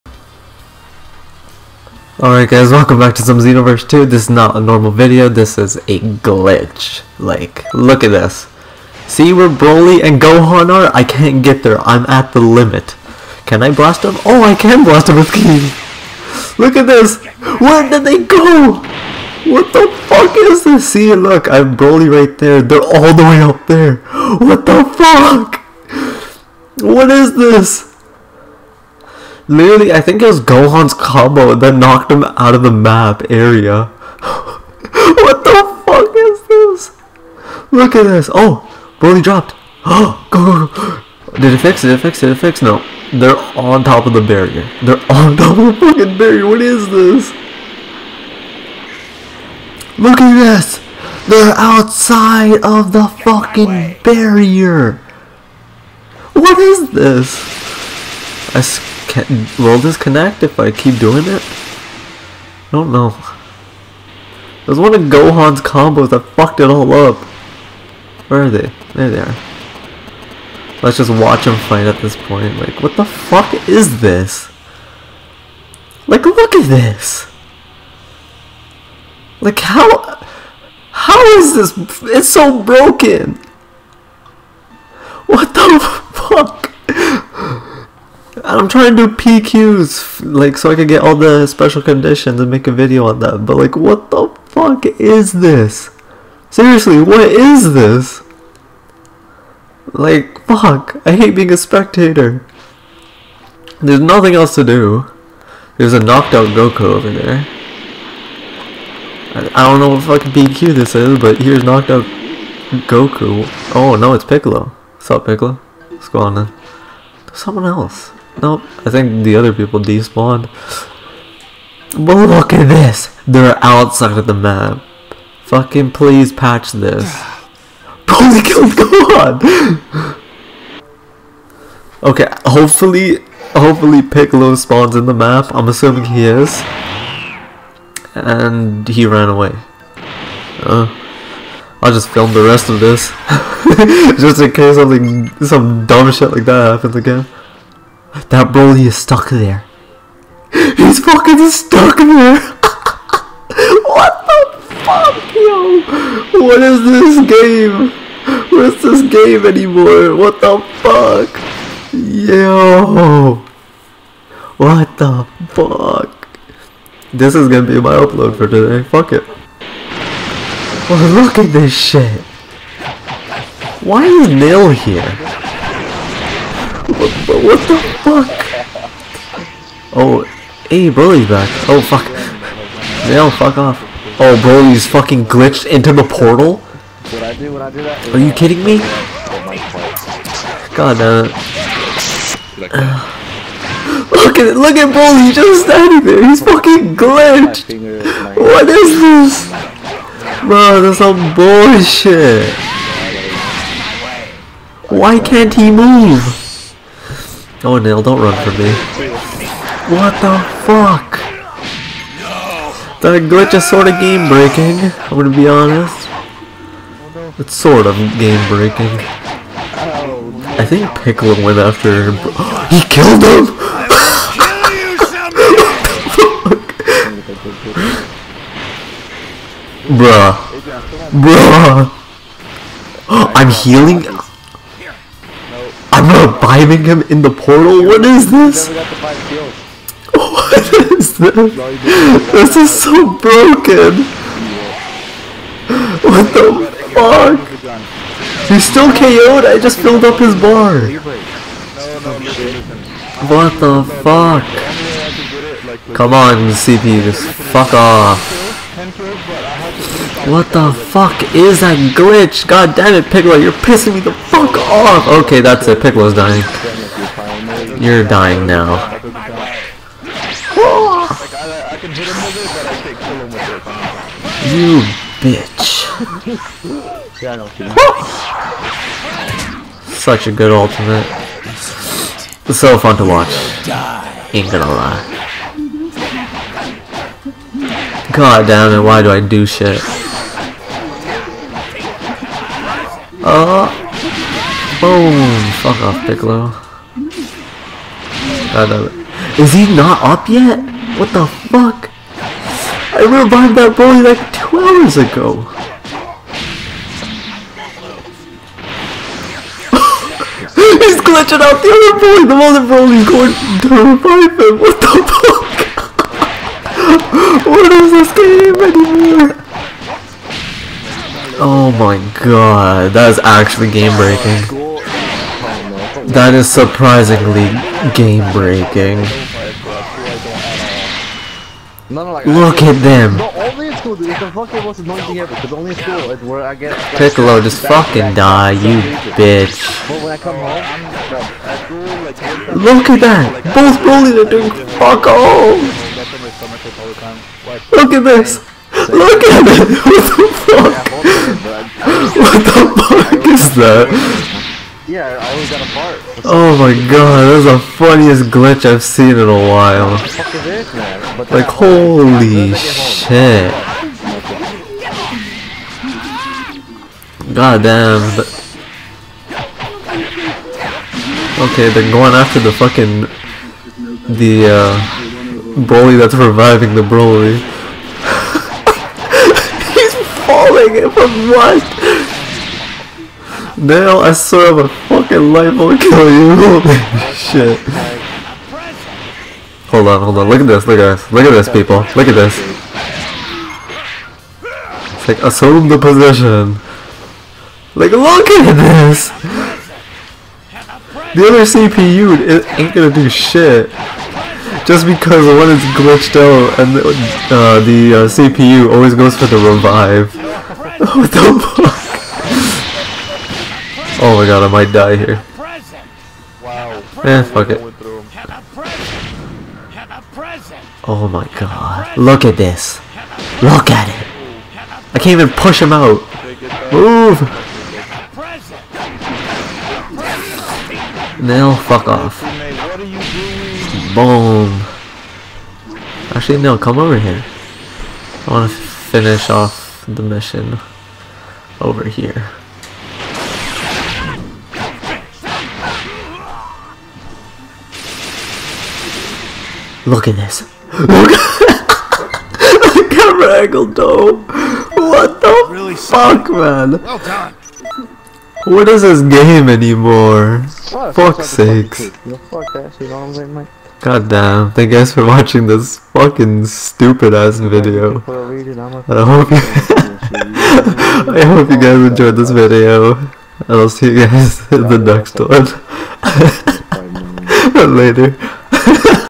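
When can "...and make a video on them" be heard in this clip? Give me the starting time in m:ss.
1:32.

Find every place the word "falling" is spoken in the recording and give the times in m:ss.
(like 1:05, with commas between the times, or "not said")
6:20.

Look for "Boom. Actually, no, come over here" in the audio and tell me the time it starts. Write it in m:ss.
7:13.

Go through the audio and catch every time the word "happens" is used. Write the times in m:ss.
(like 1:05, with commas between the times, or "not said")
2:26.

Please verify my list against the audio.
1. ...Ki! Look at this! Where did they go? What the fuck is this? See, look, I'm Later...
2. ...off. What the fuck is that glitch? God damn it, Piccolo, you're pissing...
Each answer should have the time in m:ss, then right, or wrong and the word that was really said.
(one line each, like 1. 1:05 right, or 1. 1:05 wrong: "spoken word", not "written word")
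1. 0:15 wrong: "Broly", not "Later"
2. 4:17 right.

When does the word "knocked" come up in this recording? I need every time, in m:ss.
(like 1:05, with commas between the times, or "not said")
0:31, 1:46, 1:51.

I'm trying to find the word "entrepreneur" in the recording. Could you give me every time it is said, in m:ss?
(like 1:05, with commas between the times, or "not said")
not said.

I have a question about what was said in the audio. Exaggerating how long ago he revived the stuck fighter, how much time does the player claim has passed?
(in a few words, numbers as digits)
2 hours.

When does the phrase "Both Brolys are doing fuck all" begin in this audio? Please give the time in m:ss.
5:43.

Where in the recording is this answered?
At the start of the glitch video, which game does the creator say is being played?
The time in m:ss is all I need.
0:03.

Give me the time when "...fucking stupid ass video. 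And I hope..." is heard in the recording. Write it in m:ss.
7:45.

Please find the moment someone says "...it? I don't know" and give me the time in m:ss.
1:01.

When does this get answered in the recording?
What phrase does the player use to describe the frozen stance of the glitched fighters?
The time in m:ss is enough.
6:35.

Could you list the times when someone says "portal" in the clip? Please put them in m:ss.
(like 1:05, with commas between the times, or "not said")
3:06, 3:57.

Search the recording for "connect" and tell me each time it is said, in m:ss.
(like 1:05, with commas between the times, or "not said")
0:59.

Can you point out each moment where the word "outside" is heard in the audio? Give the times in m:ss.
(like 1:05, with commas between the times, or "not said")
0:51, 2:03.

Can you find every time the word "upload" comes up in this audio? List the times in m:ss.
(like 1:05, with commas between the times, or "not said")
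2:47.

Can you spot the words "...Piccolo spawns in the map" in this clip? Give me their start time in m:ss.
2:14.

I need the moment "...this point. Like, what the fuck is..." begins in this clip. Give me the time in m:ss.
1:12.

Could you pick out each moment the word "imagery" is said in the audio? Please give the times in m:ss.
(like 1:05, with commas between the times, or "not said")
not said.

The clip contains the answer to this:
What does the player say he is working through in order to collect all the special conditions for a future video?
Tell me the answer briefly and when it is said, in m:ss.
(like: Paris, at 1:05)
PQs, at 1:29.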